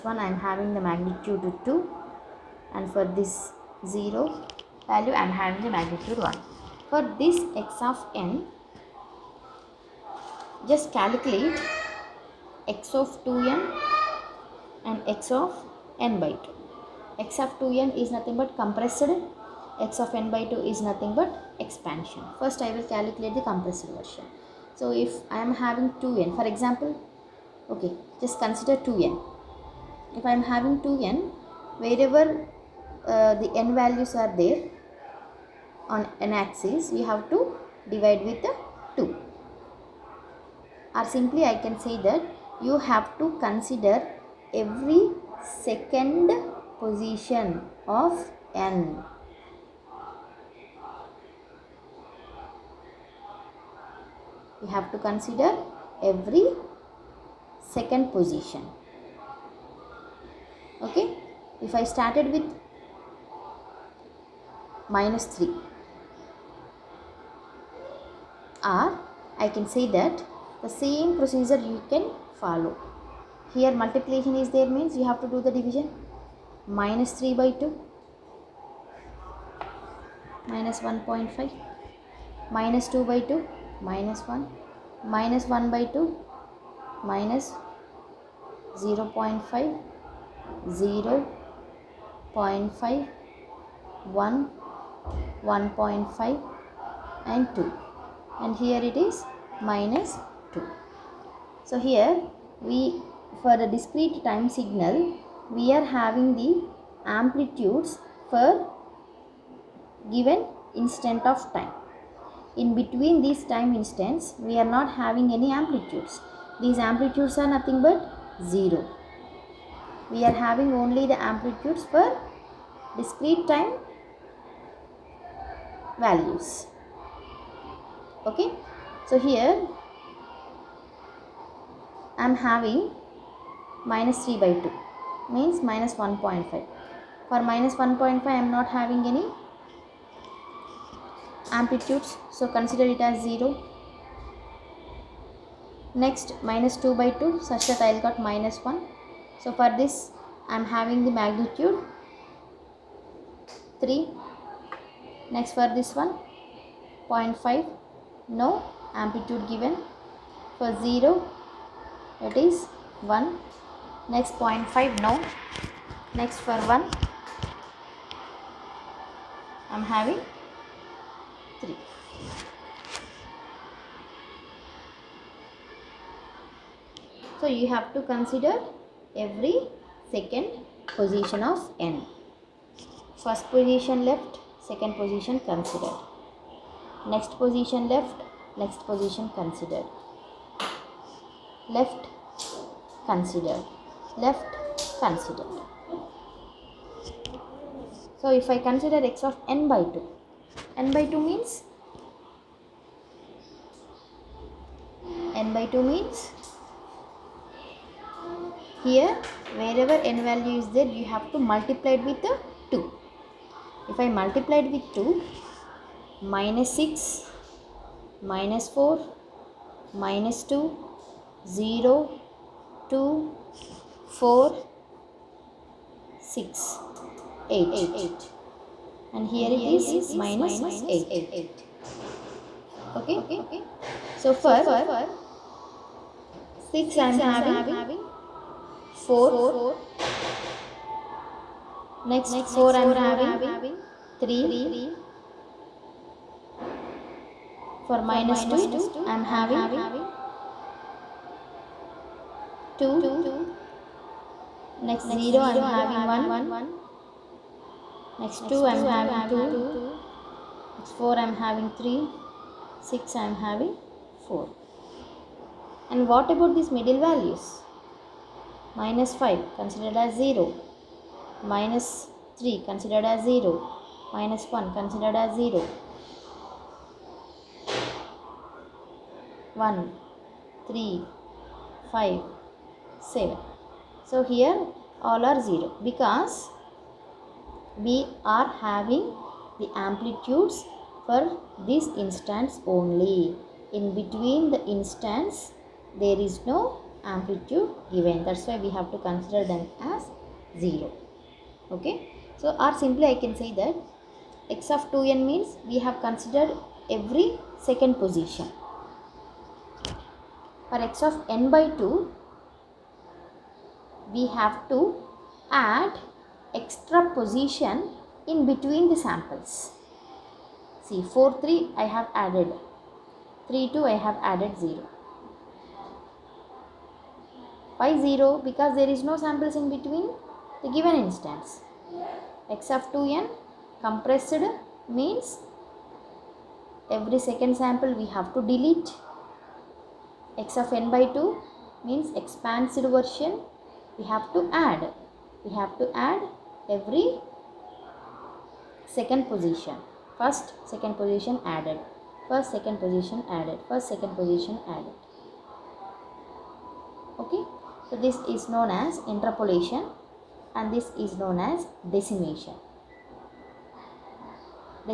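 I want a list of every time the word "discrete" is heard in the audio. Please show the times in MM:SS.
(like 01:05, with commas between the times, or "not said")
01:43, 02:02.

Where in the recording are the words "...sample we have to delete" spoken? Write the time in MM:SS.
05:37.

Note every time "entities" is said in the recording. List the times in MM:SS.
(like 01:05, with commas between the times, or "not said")
not said.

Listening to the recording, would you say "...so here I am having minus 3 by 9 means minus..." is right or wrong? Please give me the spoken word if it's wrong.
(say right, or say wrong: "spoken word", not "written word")
wrong: "2", not "9".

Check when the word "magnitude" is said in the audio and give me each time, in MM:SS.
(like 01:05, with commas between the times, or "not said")
00:00, 00:05, 02:31.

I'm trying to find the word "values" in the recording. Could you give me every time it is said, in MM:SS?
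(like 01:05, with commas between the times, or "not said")
00:04, 00:33, 02:06, 03:30, 04:27.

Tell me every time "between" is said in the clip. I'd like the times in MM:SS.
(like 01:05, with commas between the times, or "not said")
01:52, 04:53, 05:18, 05:29.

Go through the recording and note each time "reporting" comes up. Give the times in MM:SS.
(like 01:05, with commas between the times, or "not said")
not said.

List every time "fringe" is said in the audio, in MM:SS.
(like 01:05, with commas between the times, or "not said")
not said.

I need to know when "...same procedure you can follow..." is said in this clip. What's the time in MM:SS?
01:10.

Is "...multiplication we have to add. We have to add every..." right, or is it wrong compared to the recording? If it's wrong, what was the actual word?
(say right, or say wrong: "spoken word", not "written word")
wrong: "version", not "multiplication".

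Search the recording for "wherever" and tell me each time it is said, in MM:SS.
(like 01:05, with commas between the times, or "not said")
00:31, 03:29.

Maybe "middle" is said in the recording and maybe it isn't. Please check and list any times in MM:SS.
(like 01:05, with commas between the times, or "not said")
04:26.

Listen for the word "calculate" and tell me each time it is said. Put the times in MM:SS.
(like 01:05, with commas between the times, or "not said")
00:10, 00:22.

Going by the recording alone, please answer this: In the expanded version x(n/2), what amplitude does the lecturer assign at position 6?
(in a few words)
4.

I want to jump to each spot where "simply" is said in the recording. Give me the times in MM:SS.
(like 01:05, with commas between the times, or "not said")
00:41, 05:02.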